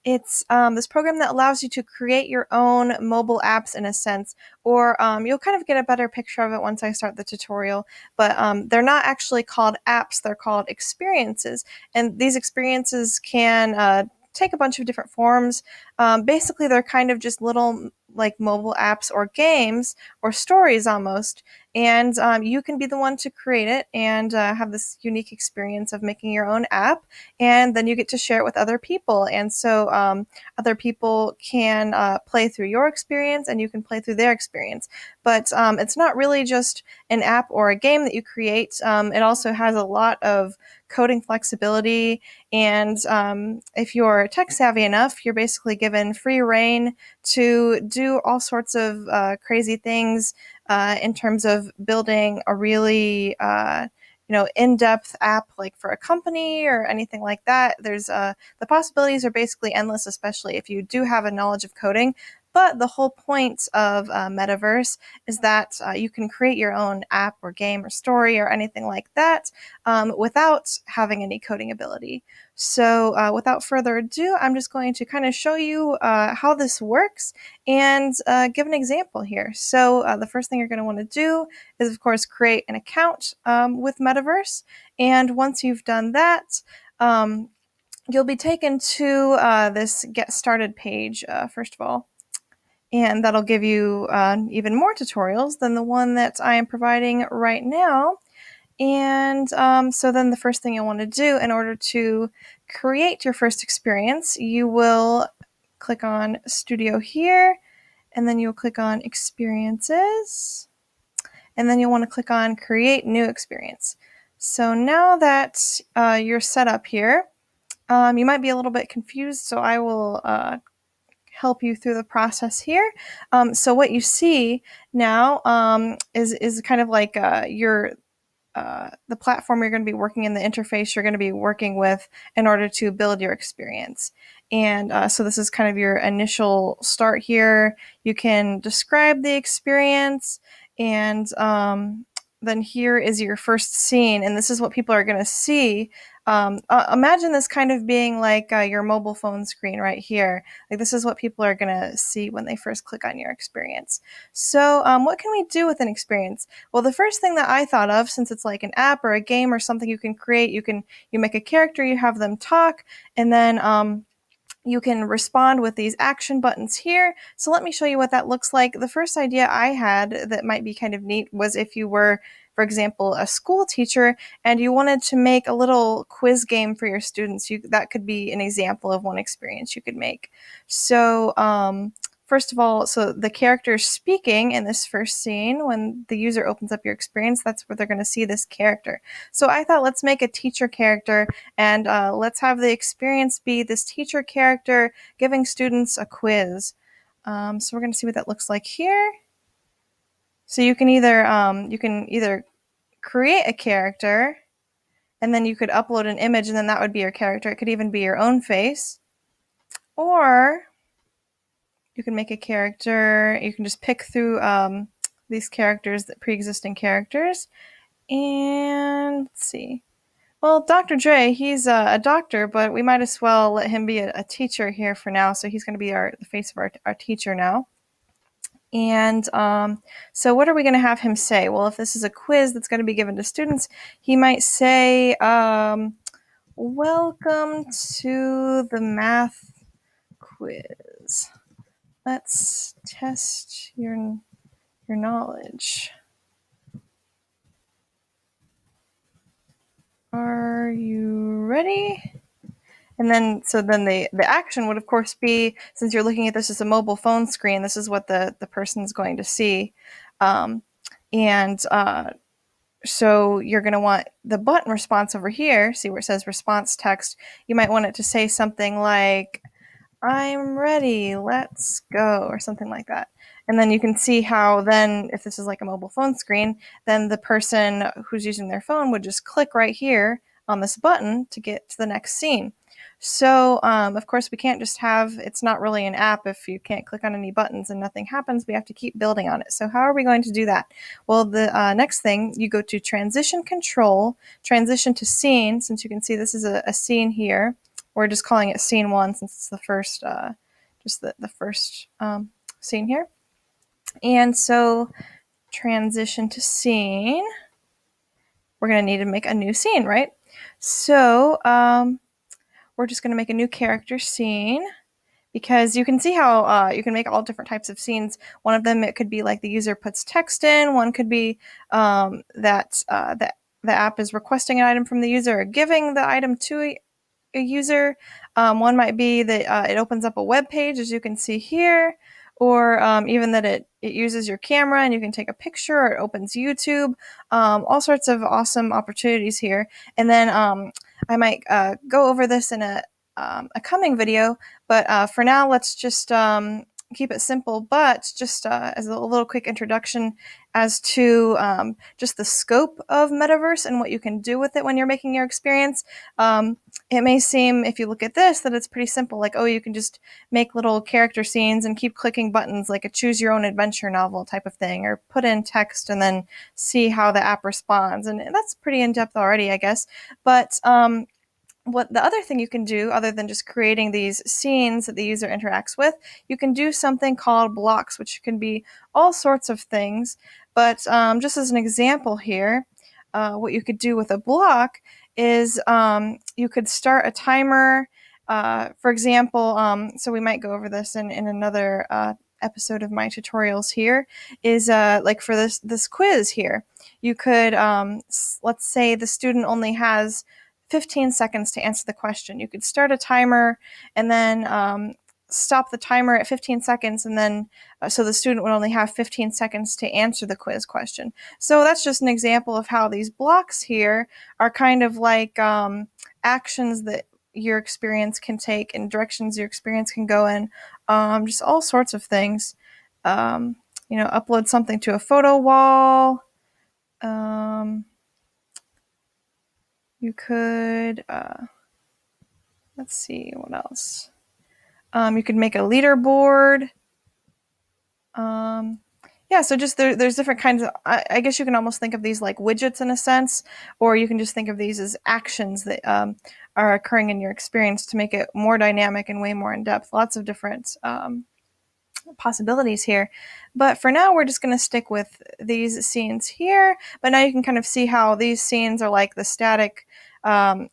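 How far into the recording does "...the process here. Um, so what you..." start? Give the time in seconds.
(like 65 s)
121 s.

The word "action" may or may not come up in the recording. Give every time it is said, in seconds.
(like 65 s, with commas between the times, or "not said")
165 s, 254 s, 416 s, 445 s.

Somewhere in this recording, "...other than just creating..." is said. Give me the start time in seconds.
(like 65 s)
372 s.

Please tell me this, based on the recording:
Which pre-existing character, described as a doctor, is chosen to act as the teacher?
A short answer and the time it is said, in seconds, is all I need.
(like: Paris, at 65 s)
Dr. Dre, at 220 s.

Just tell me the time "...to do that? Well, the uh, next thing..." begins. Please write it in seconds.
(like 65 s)
290 s.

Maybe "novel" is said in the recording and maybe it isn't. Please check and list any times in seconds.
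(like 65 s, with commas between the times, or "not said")
363 s.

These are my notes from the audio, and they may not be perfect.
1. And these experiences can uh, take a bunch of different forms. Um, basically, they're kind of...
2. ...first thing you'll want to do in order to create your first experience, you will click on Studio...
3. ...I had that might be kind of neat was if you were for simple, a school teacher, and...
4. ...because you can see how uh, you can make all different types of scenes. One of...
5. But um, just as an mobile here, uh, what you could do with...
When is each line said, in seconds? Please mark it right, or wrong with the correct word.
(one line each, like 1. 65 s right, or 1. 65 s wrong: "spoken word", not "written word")
1. 11 s right
2. 100 s right
3. 169 s wrong: "example", not "simple"
4. 315 s right
5. 380 s wrong: "example", not "mobile".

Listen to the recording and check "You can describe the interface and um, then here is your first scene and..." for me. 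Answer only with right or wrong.
wrong.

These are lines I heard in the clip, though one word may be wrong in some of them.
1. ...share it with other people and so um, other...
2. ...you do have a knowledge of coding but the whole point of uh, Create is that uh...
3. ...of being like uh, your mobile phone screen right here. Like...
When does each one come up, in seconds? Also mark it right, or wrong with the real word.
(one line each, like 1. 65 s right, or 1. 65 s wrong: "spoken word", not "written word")
1. 28 s right
2. 60 s wrong: "Metaverse", not "Create"
3. 147 s right.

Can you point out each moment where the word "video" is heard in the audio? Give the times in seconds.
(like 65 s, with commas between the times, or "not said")
343 s.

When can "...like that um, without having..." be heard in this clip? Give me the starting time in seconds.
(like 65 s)
68 s.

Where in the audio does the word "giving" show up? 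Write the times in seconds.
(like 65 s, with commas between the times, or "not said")
195 s, 325 s.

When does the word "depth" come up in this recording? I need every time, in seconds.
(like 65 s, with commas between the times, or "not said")
54 s, 368 s, 449 s.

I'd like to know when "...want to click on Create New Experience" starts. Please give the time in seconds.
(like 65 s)
111 s.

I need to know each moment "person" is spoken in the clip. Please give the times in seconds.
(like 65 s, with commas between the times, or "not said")
258 s, 277 s.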